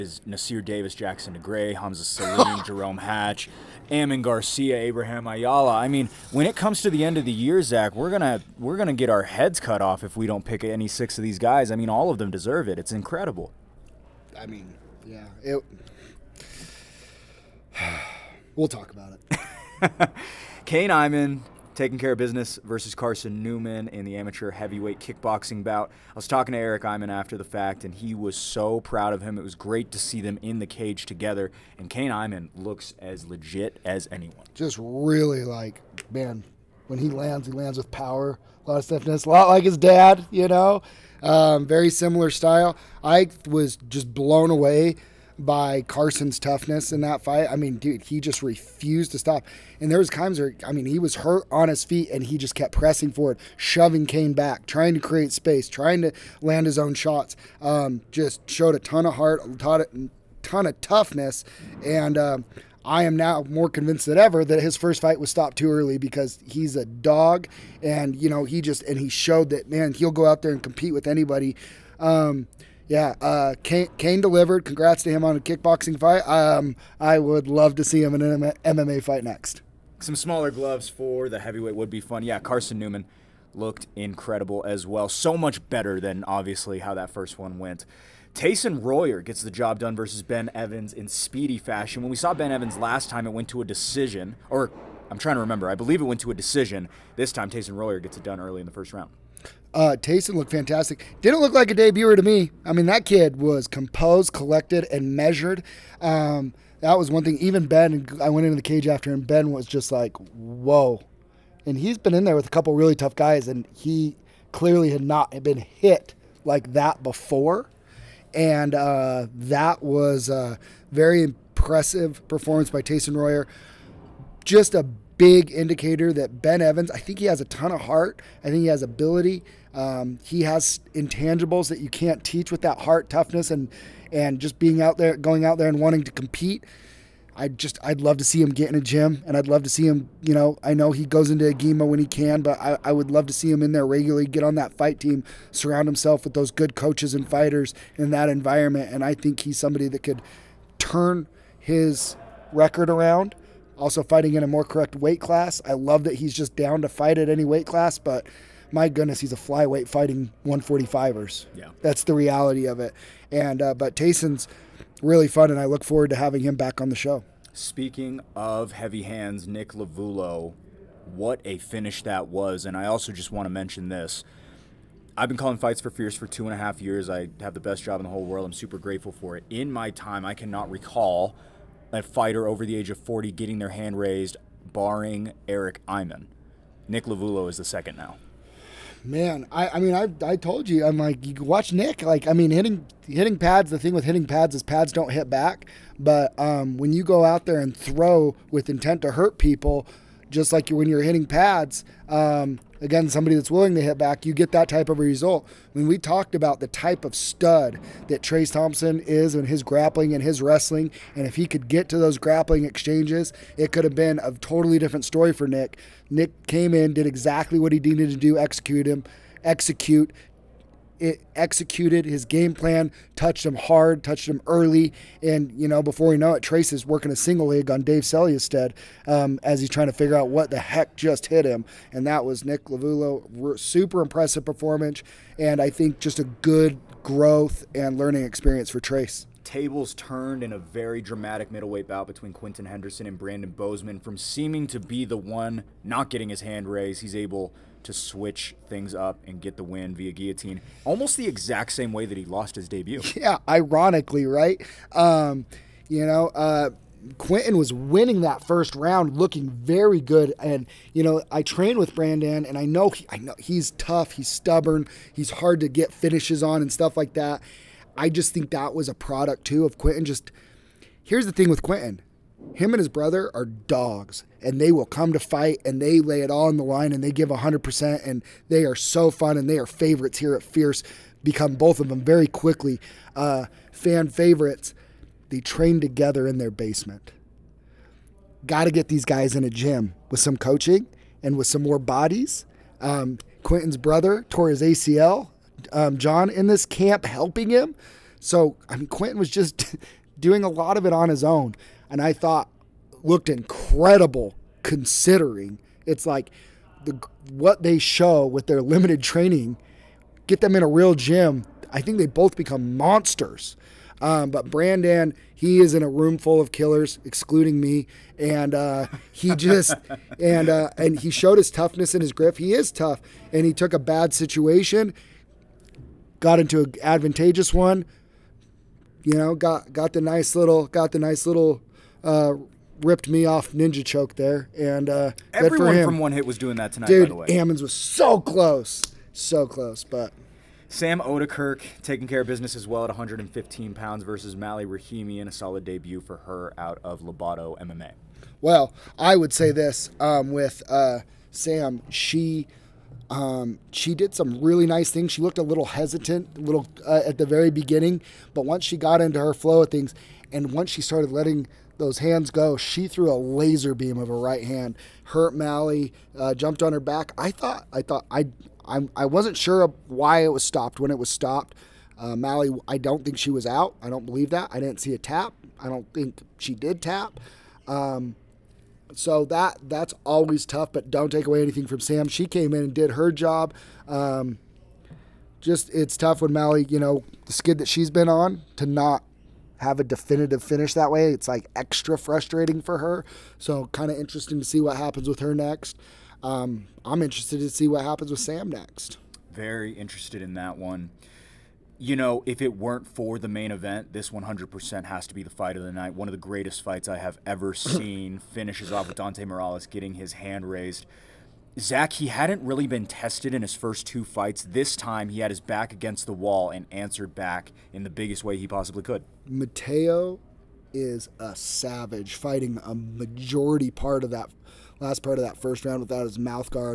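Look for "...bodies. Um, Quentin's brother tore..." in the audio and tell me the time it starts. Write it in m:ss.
4:51.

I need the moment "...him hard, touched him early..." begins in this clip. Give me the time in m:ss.
3:43.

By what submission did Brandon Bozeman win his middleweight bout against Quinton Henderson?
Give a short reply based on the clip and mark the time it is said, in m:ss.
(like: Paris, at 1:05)
guillotine, at 4:10.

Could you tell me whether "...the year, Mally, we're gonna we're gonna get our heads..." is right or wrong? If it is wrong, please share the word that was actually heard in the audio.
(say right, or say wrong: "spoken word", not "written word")
wrong: "Zach", not "Mally".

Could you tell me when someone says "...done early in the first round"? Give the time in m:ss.
1:38.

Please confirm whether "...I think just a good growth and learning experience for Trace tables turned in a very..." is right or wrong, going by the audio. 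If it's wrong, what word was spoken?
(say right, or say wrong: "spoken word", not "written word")
right.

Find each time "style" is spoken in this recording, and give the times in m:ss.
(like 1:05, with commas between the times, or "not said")
0:42.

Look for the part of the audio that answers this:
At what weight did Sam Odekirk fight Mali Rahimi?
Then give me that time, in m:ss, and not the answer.
5:42.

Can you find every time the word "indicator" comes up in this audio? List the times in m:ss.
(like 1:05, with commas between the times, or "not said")
2:05.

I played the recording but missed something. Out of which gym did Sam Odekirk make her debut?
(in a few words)
Lobato MMA.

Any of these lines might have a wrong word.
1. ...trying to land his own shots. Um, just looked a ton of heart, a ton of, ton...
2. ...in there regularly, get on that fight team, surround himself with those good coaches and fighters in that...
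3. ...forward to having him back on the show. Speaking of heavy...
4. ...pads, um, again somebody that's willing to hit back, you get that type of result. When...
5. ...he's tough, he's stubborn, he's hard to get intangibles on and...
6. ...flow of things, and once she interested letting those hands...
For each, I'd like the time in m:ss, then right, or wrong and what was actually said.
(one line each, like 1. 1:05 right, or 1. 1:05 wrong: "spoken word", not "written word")
1. 0:55 wrong: "showed", not "looked"
2. 2:23 right
3. 2:45 right
4. 3:21 right
5. 4:23 wrong: "finishes", not "intangibles"
6. 5:59 wrong: "started", not "interested".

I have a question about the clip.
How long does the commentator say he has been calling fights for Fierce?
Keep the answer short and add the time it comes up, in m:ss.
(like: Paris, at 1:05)
two and a half years, at 2:56.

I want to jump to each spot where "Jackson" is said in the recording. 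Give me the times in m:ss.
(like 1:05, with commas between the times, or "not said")
0:00.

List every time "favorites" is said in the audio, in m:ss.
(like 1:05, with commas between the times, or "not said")
4:39, 4:44.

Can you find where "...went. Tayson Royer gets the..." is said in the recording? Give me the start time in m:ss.
1:27.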